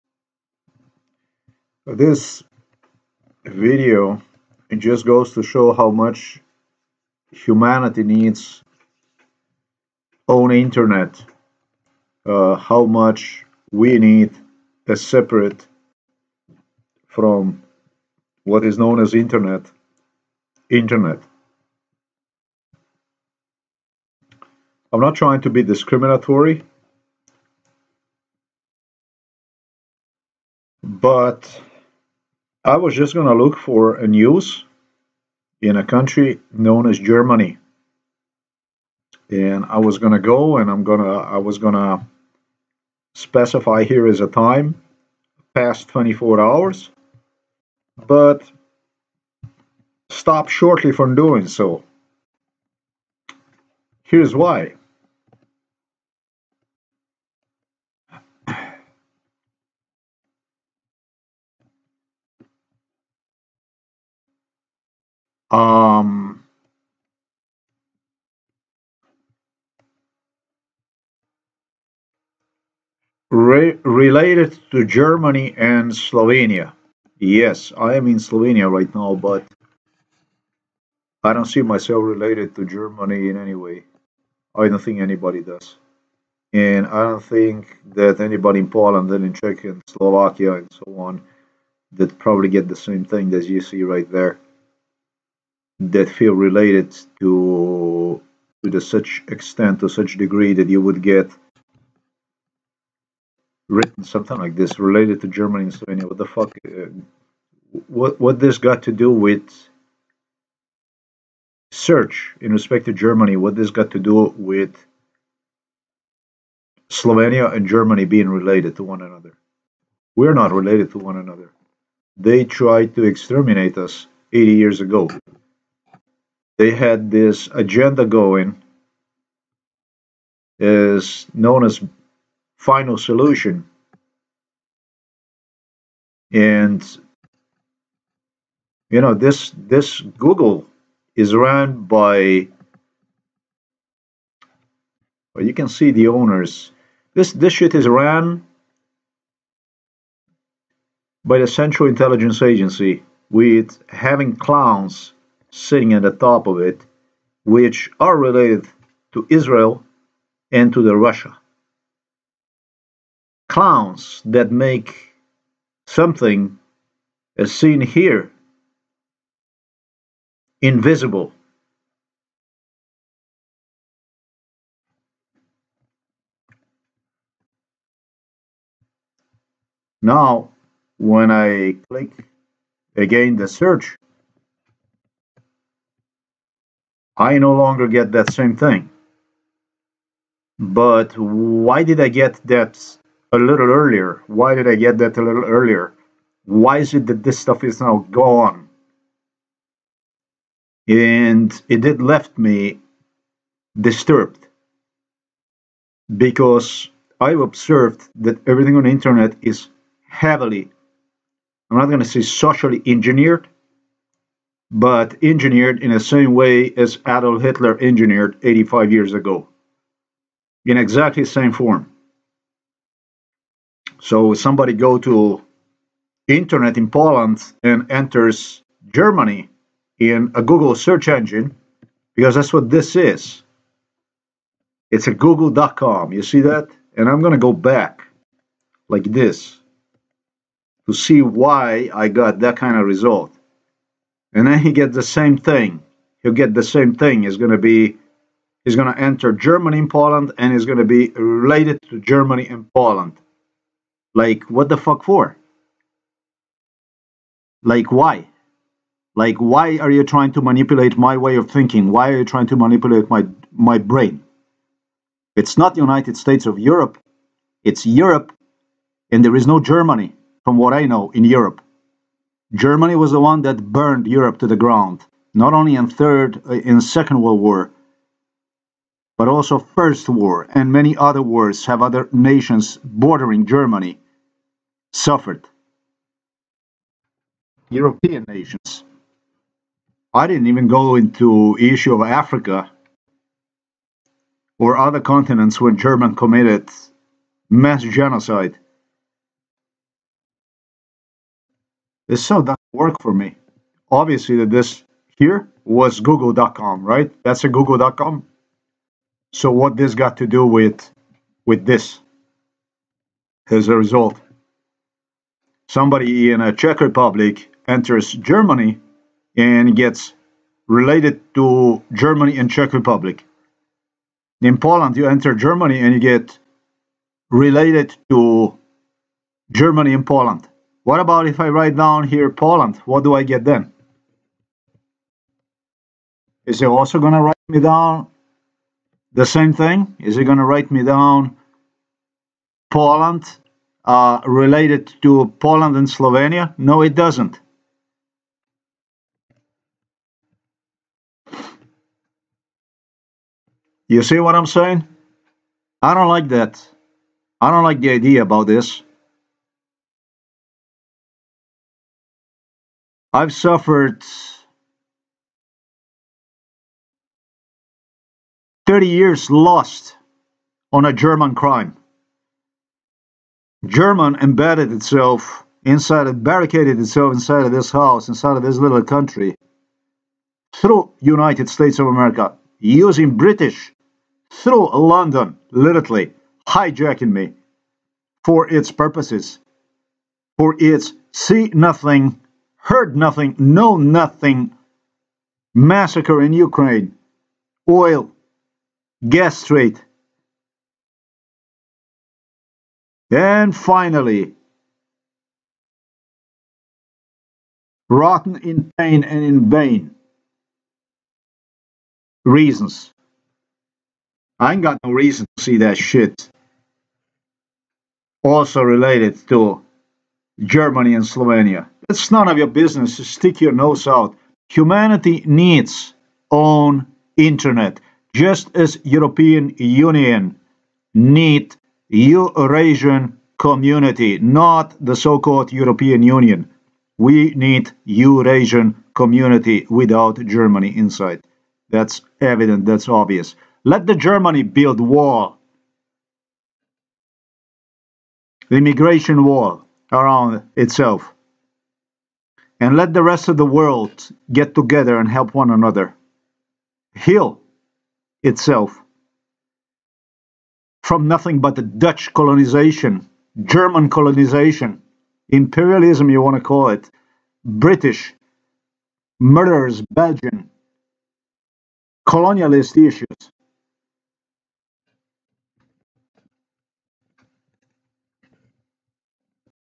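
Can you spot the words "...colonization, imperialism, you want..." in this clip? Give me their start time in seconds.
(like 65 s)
463 s.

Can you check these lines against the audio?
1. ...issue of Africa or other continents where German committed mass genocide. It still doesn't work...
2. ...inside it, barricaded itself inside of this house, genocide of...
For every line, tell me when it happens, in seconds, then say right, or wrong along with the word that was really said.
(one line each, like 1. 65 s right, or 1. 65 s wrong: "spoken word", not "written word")
1. 291 s right
2. 375 s wrong: "inside", not "genocide".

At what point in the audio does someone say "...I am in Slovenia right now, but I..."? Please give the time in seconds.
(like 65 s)
77 s.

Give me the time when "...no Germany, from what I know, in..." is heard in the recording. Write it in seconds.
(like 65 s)
269 s.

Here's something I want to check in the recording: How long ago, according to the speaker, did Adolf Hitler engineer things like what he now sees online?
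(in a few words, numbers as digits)
85 years.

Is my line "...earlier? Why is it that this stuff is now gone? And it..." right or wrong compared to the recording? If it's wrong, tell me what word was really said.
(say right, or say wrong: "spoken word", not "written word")
right.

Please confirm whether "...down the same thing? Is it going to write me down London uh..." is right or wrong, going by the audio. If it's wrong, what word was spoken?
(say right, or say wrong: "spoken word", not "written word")
wrong: "Poland", not "London".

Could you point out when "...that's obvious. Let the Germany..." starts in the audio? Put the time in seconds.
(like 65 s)
442 s.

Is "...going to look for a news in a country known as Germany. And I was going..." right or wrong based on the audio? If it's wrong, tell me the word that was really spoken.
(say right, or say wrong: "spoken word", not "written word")
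right.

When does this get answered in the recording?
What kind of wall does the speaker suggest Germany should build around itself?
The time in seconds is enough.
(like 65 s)
448 s.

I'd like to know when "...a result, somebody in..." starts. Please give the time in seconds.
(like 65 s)
313 s.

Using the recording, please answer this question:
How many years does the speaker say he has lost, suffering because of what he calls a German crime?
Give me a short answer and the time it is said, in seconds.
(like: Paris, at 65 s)
30 years, at 368 s.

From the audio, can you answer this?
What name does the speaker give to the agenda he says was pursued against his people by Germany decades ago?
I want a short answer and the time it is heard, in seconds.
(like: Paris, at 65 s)
final solution, at 132 s.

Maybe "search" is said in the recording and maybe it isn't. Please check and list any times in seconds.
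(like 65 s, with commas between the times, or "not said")
111 s, 183 s, 230 s.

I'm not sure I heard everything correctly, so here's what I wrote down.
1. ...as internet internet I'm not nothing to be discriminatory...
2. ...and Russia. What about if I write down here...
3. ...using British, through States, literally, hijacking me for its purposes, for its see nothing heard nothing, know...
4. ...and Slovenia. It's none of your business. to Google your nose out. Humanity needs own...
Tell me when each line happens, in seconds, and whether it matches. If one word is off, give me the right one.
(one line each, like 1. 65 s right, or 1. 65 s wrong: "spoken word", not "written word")
1. 19 s wrong: "trying", not "nothing"
2. 329 s wrong: "Poland", not "Russia"
3. 382 s wrong: "London", not "States"
4. 420 s wrong: "Stick", not "Google".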